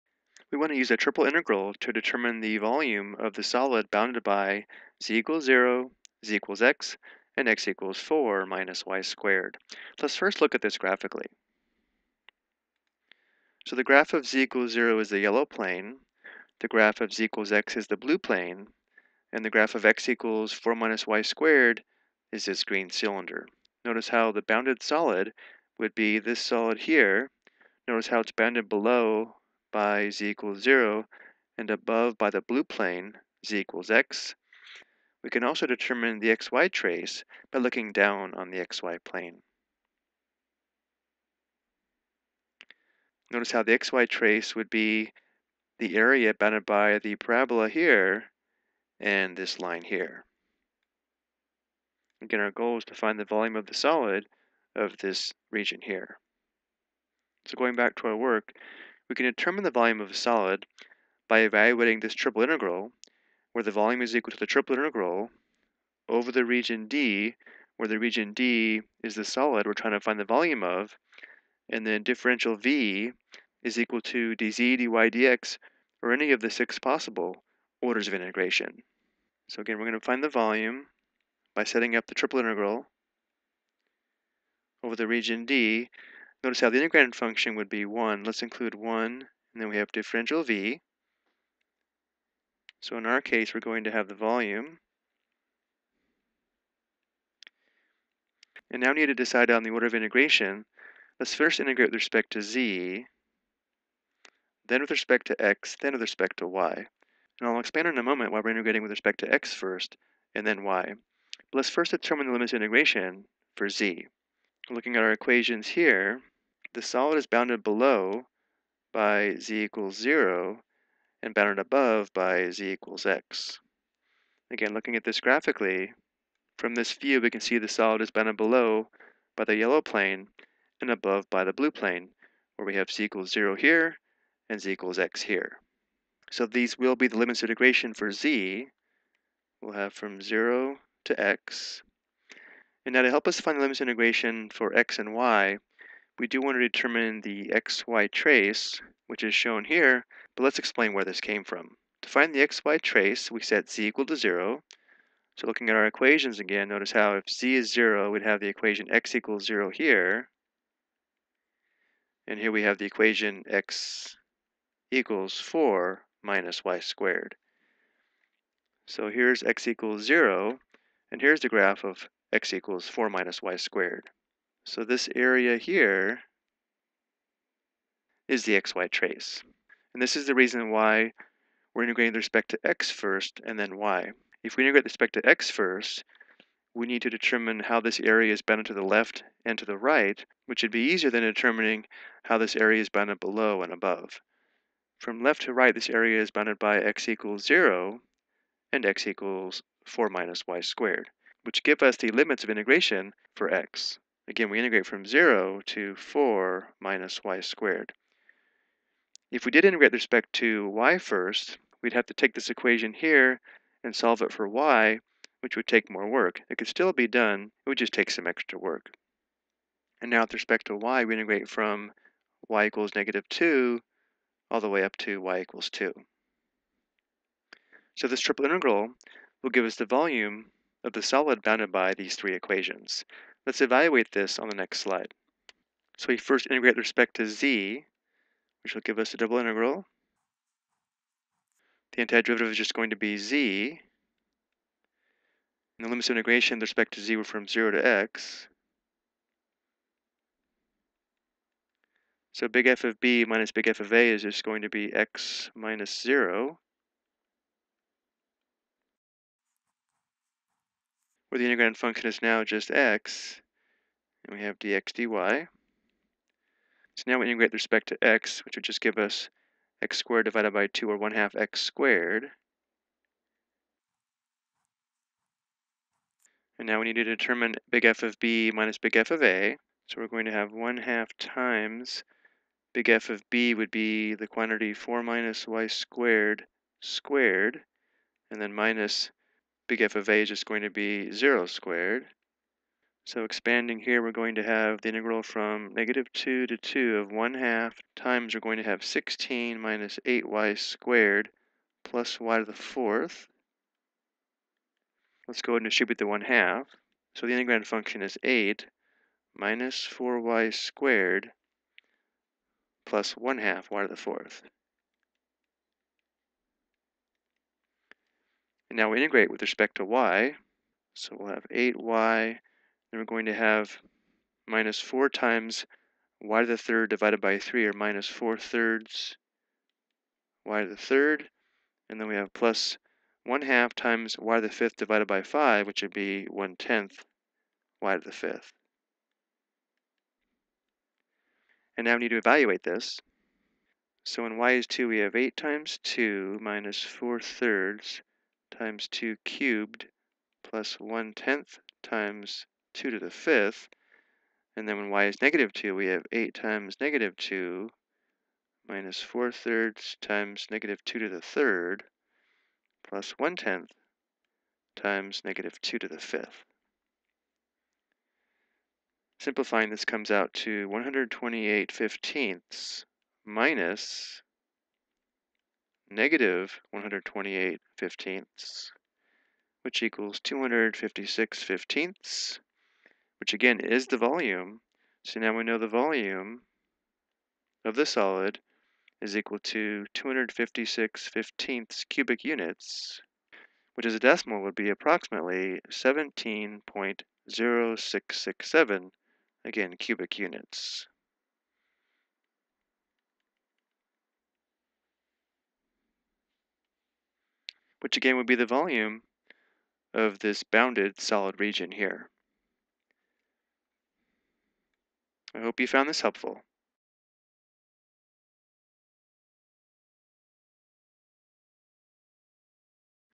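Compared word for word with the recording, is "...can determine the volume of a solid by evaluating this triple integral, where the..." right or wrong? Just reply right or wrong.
right.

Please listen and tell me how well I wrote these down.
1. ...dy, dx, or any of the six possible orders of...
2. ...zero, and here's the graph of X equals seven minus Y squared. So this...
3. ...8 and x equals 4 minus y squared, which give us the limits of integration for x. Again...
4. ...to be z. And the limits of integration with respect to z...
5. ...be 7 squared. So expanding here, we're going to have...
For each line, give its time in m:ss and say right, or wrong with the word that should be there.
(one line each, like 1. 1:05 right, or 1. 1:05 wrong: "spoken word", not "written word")
1. 1:14 right
2. 2:50 wrong: "four", not "seven"
3. 3:17 wrong: "0", not "8"
4. 4:02 right
5. 4:50 wrong: "0", not "7".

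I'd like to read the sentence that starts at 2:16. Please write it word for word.
So these will be the limits of integration for z.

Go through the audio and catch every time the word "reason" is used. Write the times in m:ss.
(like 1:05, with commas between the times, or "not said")
3:00.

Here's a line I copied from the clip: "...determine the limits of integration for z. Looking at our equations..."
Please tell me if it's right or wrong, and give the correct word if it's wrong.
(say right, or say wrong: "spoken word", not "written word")
right.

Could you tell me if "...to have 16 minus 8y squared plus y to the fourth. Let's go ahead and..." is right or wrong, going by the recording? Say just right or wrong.
right.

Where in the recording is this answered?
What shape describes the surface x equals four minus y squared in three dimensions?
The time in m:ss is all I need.
0:22.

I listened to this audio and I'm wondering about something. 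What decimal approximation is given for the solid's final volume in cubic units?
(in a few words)
17.0667.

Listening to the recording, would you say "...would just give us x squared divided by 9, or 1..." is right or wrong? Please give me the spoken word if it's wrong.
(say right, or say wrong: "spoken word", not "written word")
wrong: "2", not "9".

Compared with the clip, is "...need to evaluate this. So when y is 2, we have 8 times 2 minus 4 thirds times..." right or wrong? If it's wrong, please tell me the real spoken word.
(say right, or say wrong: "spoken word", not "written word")
right.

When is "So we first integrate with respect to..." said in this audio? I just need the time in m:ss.
3:55.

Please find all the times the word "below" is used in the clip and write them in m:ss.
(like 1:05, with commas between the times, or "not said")
0:28, 1:57, 2:08, 3:13.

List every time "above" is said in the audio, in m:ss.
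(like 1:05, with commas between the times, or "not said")
0:31, 2:01, 2:10, 3:13.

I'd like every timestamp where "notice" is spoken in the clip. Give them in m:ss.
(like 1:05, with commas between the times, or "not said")
0:23, 0:27, 0:43, 1:26, 2:36.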